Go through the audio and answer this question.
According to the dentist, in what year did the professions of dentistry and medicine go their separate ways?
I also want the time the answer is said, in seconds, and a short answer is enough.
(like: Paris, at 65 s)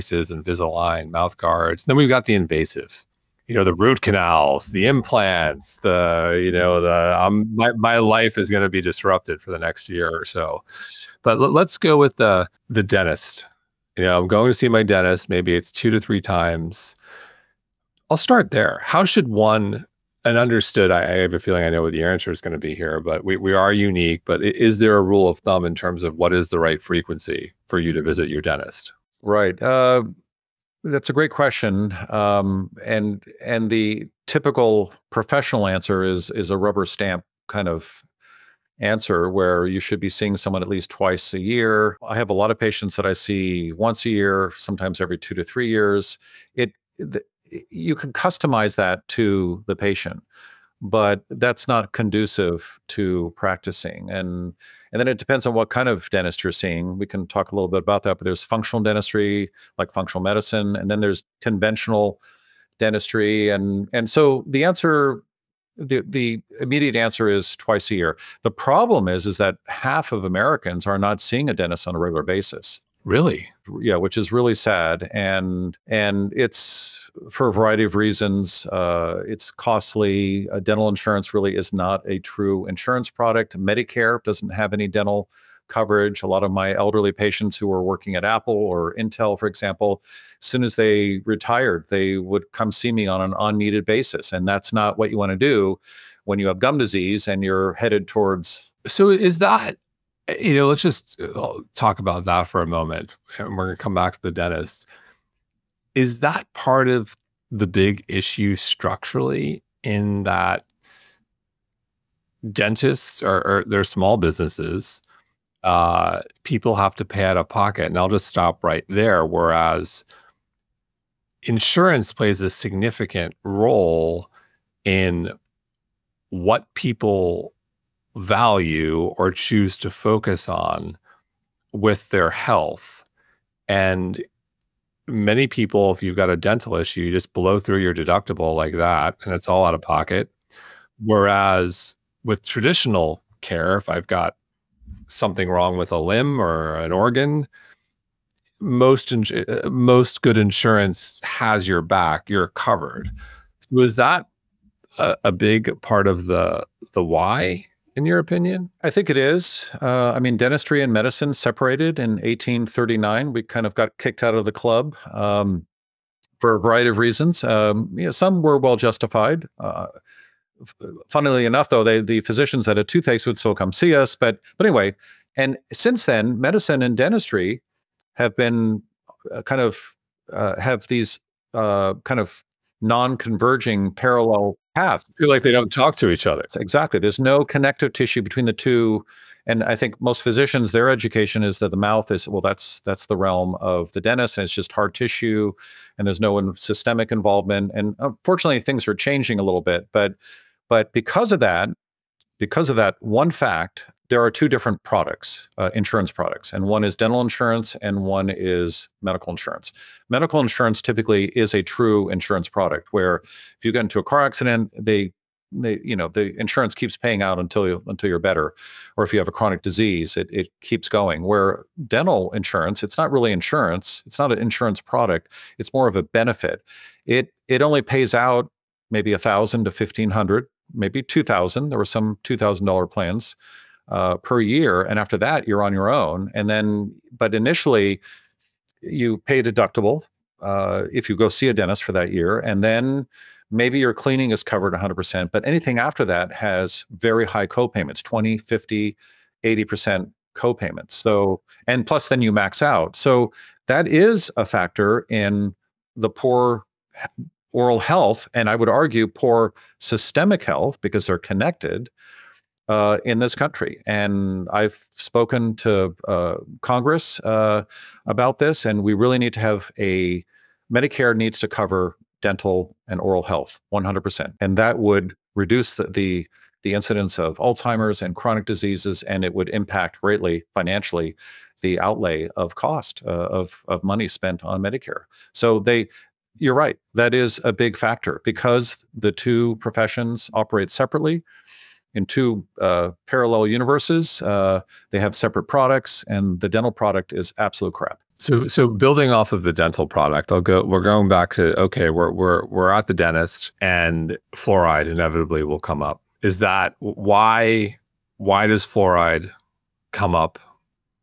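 1839, at 162 s.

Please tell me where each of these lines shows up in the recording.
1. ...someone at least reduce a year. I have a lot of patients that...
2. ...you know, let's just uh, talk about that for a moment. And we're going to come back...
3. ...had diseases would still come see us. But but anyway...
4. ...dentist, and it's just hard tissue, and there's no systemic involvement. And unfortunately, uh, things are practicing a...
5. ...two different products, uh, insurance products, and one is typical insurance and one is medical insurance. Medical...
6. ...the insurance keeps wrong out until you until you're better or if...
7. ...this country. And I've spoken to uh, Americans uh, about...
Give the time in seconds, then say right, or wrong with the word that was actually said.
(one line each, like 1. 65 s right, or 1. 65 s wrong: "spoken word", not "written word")
1. 40 s wrong: "twice", not "reduce"
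2. 100 s right
3. 172 s wrong: "toothaches", not "diseases"
4. 194 s wrong: "changing", not "practicing"
5. 204 s wrong: "dental", not "typical"
6. 216 s wrong: "paying", not "wrong"
7. 263 s wrong: "Congress", not "Americans".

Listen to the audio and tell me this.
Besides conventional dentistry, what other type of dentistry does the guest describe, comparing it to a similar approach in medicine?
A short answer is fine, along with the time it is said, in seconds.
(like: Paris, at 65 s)
Functional dentistry, at 58 s.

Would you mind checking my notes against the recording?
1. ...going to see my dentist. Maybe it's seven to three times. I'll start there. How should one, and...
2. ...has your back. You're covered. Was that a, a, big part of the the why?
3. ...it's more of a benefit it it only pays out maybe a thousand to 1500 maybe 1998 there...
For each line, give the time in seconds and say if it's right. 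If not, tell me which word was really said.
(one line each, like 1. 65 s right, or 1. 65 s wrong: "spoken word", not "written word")
1. 14 s wrong: "two", not "seven"
2. 151 s right
3. 225 s wrong: "2000", not "1998".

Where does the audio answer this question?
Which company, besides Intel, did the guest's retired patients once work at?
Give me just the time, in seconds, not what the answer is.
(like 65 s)
88 s.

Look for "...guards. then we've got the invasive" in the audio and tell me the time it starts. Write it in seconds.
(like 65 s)
1 s.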